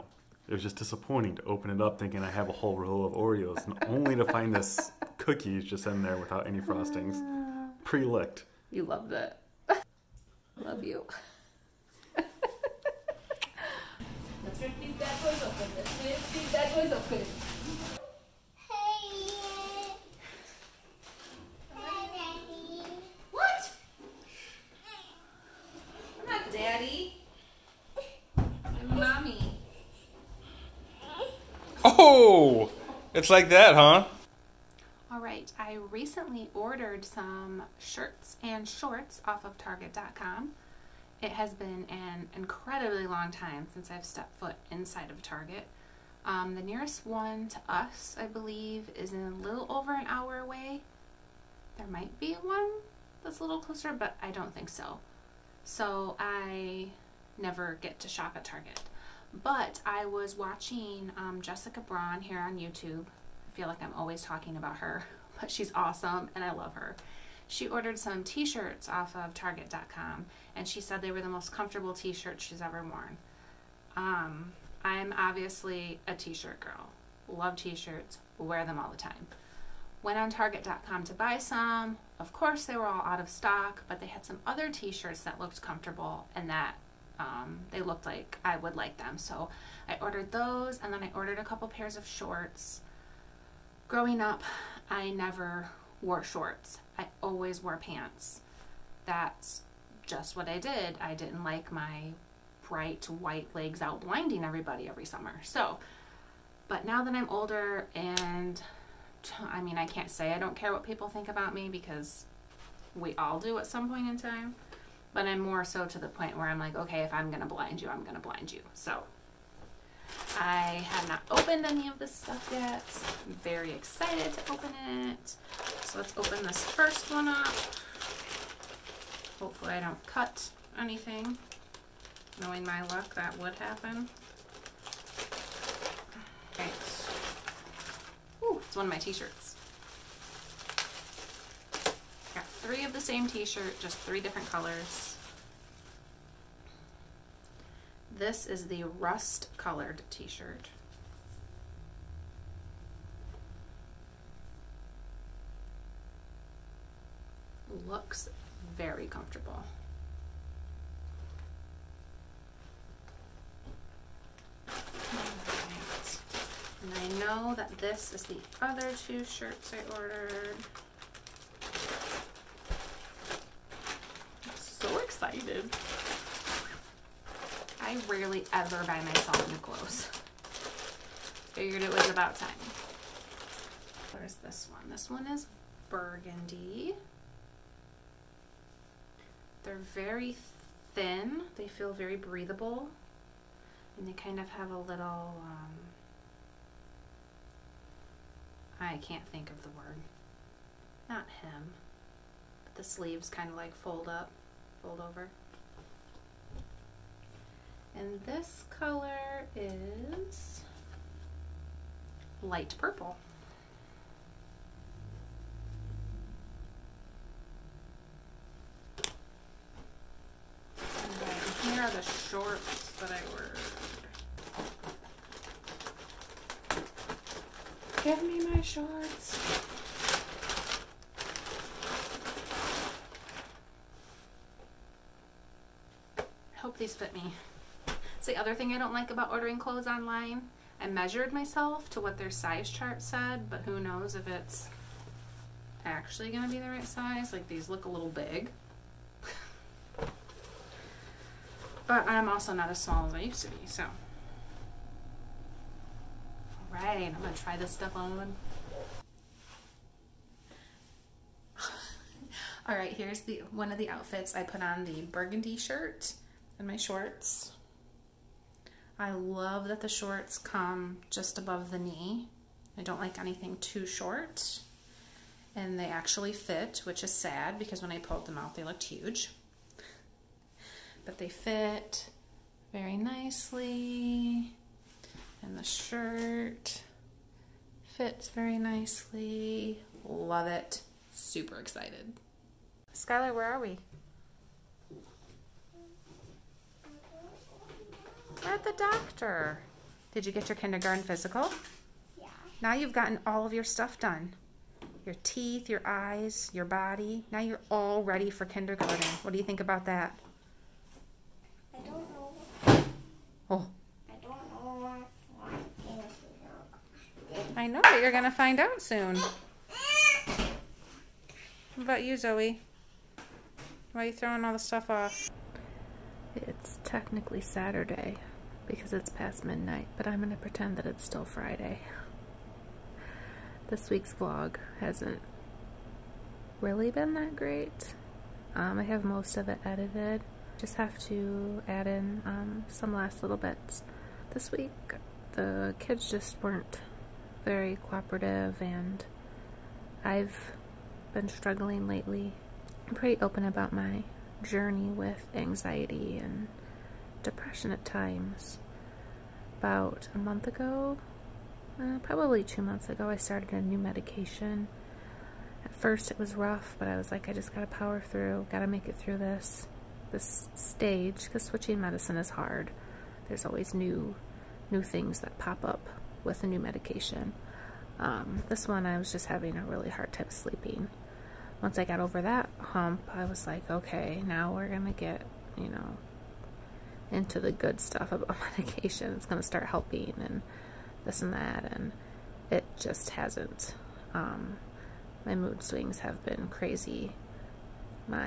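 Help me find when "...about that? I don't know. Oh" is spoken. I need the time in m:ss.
5:09.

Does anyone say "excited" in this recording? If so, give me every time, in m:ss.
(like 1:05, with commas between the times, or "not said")
2:03, 2:54, 4:51.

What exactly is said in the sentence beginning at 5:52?
I'm pretty open about my journey with anxiety and depression at times.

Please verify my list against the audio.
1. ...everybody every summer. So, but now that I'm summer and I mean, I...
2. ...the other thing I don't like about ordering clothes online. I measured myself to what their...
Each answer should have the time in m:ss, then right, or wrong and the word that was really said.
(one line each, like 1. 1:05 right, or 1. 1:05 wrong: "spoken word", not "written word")
1. 1:44 wrong: "older", not "summer"
2. 3:58 right.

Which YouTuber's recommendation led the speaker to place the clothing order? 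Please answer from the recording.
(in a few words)
Jessica Braun.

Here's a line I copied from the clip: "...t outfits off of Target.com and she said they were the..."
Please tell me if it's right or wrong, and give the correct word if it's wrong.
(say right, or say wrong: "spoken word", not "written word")
wrong: "shirts", not "outfits".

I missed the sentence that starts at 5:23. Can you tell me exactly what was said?
Why are you throwing all the stuff off?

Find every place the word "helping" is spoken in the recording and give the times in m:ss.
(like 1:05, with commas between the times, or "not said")
6:29.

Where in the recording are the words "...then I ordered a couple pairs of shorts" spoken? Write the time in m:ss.
1:30.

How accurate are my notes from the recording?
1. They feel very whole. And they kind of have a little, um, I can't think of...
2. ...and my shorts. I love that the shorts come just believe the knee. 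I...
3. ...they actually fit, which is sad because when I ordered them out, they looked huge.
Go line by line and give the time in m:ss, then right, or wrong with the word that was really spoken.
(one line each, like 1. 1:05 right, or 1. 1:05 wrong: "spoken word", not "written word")
1. 3:11 wrong: "breathable", not "whole"
2. 4:26 wrong: "above", not "believe"
3. 4:35 wrong: "pulled", not "ordered".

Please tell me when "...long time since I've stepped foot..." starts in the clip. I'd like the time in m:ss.
0:43.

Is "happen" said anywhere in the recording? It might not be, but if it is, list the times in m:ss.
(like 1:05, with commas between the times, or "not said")
2:13.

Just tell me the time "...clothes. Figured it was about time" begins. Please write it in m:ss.
2:59.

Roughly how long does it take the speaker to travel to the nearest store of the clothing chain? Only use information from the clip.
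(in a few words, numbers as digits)
a little over an hour.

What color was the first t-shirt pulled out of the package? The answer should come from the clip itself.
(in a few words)
rust.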